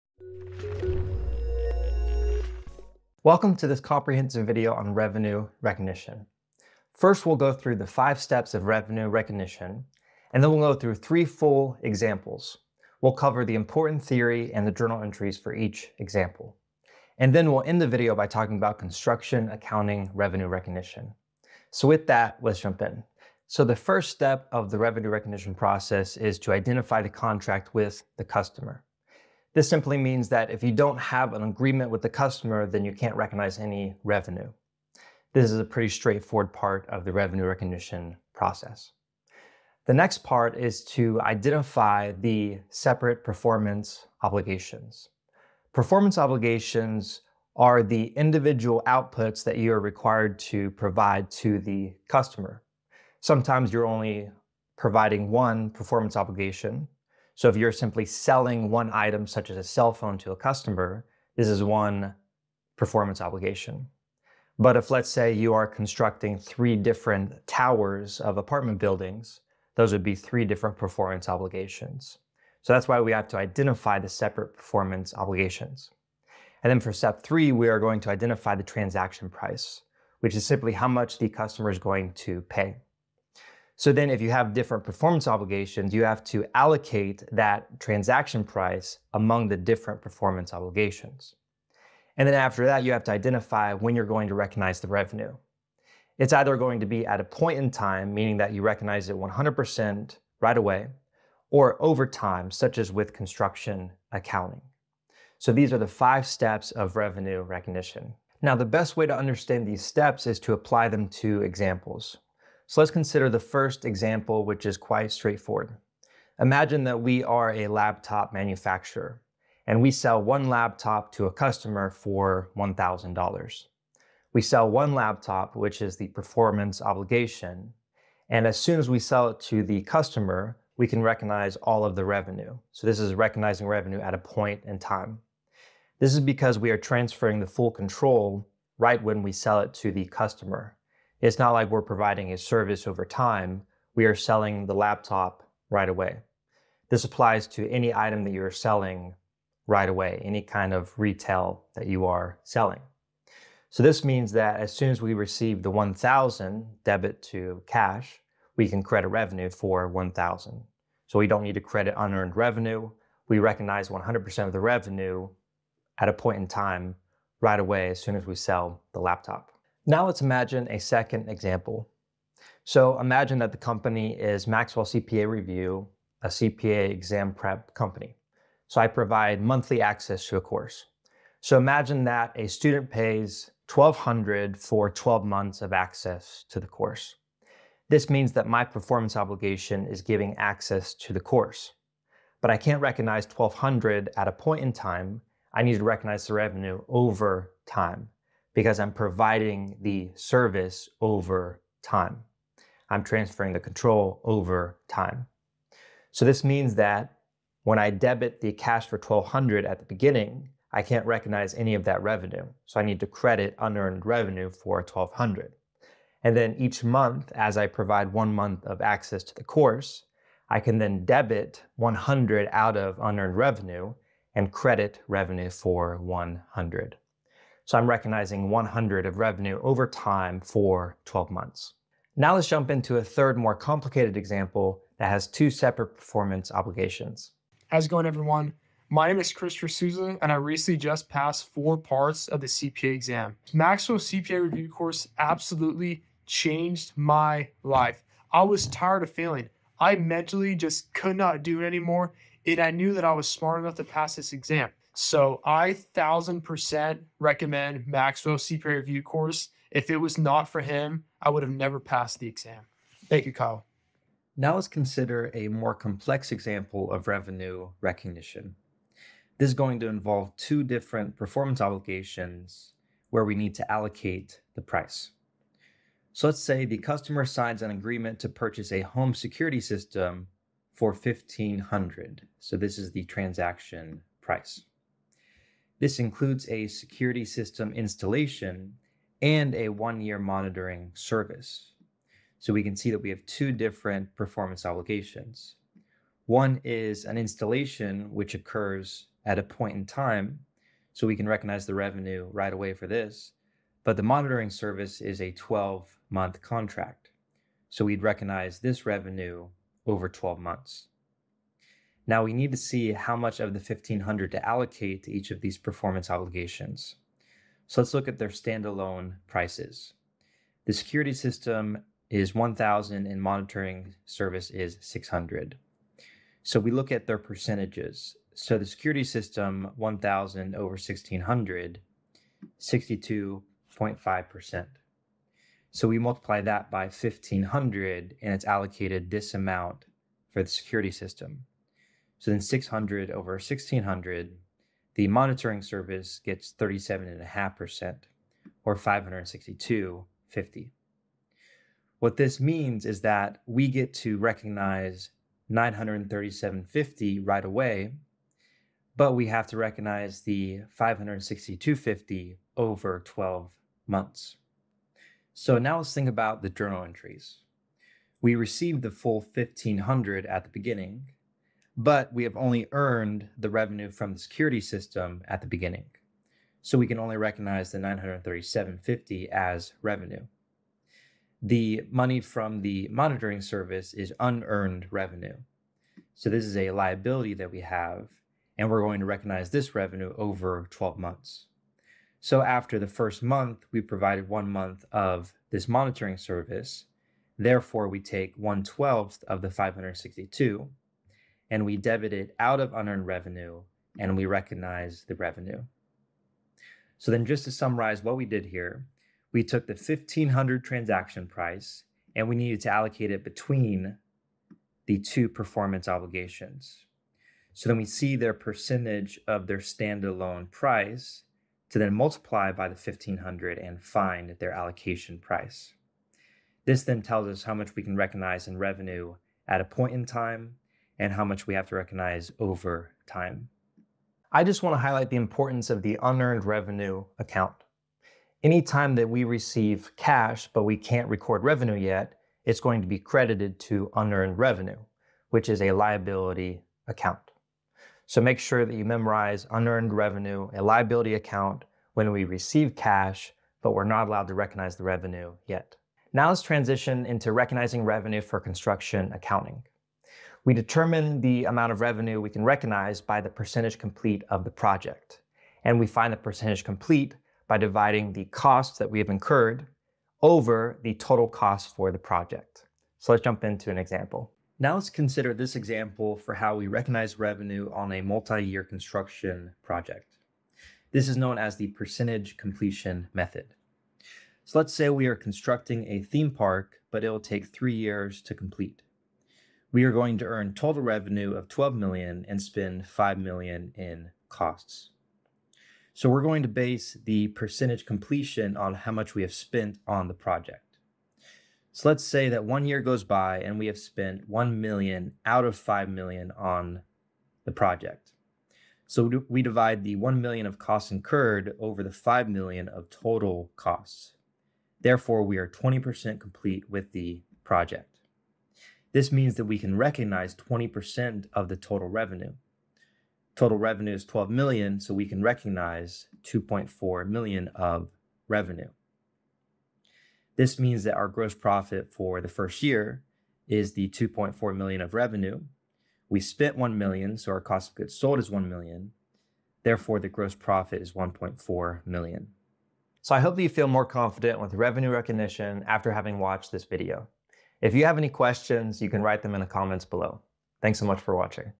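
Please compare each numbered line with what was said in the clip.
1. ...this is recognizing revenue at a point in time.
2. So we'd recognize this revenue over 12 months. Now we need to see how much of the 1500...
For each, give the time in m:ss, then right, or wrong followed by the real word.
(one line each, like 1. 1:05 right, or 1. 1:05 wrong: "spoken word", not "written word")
1. 2:12 right
2. 5:07 right.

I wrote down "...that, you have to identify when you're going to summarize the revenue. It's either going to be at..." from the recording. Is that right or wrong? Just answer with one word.
wrong.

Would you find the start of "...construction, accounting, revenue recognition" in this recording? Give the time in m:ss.
0:18.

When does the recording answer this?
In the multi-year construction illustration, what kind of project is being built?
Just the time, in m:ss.
8:06.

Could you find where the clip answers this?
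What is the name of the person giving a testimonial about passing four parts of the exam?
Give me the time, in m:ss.
3:59.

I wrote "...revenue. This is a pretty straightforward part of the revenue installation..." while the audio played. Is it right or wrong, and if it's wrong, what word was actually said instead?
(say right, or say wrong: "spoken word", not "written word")
wrong: "recognition", not "installation".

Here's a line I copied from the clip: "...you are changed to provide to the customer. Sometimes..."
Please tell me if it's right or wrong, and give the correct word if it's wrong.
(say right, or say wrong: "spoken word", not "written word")
wrong: "required", not "changed".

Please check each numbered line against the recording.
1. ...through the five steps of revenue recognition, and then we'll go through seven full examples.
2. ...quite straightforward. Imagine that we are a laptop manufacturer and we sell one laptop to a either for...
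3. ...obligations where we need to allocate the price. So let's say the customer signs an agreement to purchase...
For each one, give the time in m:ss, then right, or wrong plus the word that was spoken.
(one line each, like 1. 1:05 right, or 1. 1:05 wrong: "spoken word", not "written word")
1. 0:07 wrong: "three", not "seven"
2. 1:54 wrong: "customer", not "either"
3. 4:31 right.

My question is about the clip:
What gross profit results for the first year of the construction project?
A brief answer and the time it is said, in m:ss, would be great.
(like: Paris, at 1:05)
1.4 million, at 9:00.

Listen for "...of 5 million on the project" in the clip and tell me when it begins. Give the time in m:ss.
8:25.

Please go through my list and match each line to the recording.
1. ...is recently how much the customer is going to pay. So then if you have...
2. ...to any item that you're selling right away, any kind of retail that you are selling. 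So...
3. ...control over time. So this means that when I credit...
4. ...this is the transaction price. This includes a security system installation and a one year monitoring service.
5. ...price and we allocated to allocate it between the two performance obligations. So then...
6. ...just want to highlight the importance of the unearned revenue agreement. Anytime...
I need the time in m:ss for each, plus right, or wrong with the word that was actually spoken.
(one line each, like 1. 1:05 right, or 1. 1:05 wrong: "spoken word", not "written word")
1. 1:20 wrong: "simply", not "recently"
2. 2:27 right
3. 3:23 wrong: "debit", not "credit"
4. 4:42 right
5. 6:51 wrong: "needed", not "allocated"
6. 7:14 wrong: "account", not "agreement".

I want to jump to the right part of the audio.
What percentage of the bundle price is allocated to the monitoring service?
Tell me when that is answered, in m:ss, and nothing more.
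5:46.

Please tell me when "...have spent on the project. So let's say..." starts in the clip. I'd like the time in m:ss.
8:19.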